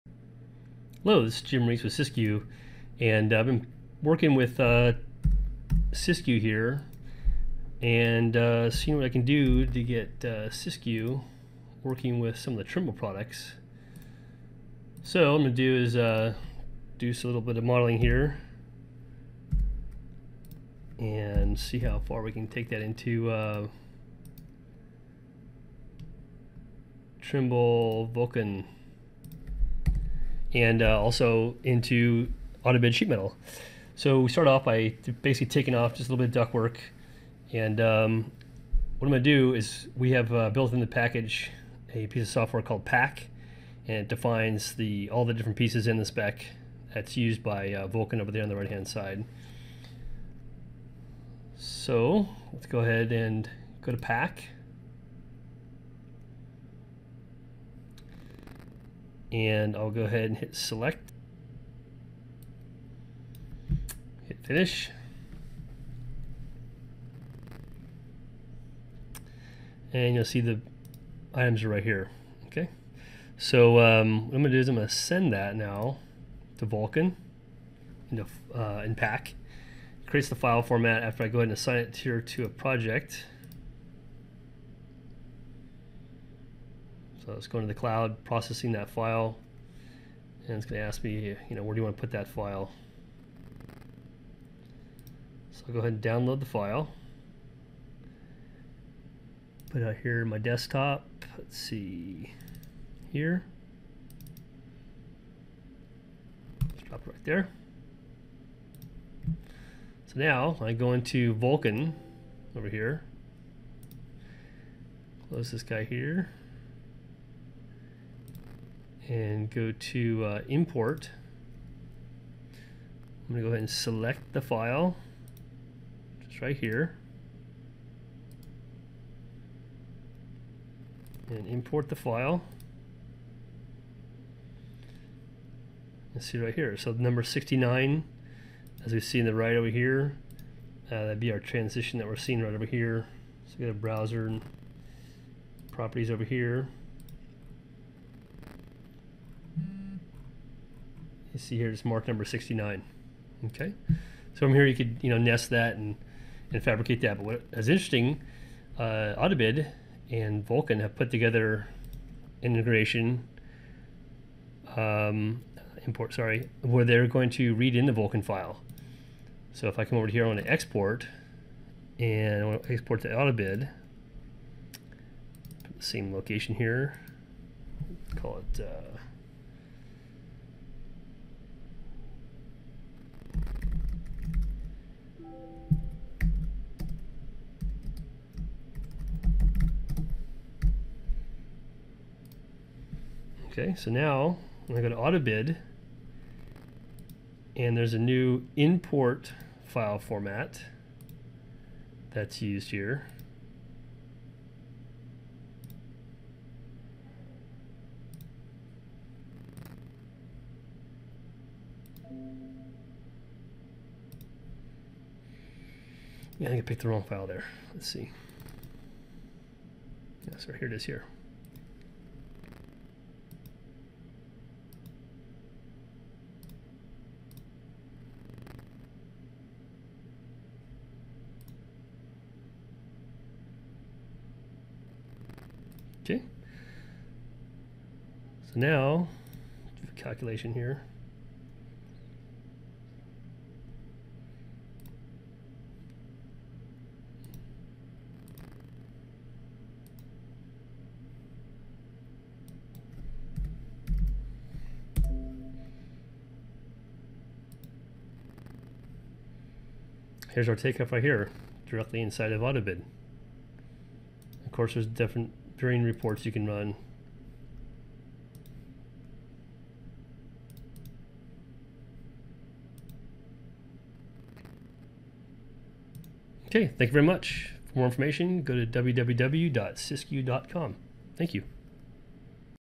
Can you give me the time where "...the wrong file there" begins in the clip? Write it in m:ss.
3:36.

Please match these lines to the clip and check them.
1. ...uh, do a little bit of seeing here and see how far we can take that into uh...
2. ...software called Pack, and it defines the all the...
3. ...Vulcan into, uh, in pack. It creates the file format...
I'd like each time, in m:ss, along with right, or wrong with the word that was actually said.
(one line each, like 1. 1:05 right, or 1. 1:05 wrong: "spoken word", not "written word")
1. 0:15 wrong: "modeling", not "seeing"
2. 0:42 right
3. 1:16 right.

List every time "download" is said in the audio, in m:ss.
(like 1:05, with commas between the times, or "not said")
1:36.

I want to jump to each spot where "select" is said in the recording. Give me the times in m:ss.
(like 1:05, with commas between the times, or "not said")
1:00, 2:03.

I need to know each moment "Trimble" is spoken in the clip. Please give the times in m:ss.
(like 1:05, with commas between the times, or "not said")
0:12, 0:27.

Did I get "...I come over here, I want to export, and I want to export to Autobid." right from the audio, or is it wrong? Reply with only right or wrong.
right.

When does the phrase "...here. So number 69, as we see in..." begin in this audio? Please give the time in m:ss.
2:16.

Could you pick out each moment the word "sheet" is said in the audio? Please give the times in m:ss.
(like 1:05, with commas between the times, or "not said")
0:32.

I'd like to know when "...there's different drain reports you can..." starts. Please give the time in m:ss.
4:24.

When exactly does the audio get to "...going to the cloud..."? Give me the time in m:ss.
1:27.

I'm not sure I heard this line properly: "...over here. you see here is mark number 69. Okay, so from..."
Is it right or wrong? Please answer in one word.
right.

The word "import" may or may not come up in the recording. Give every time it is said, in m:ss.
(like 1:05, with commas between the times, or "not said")
2:00, 2:11, 2:45, 3:18.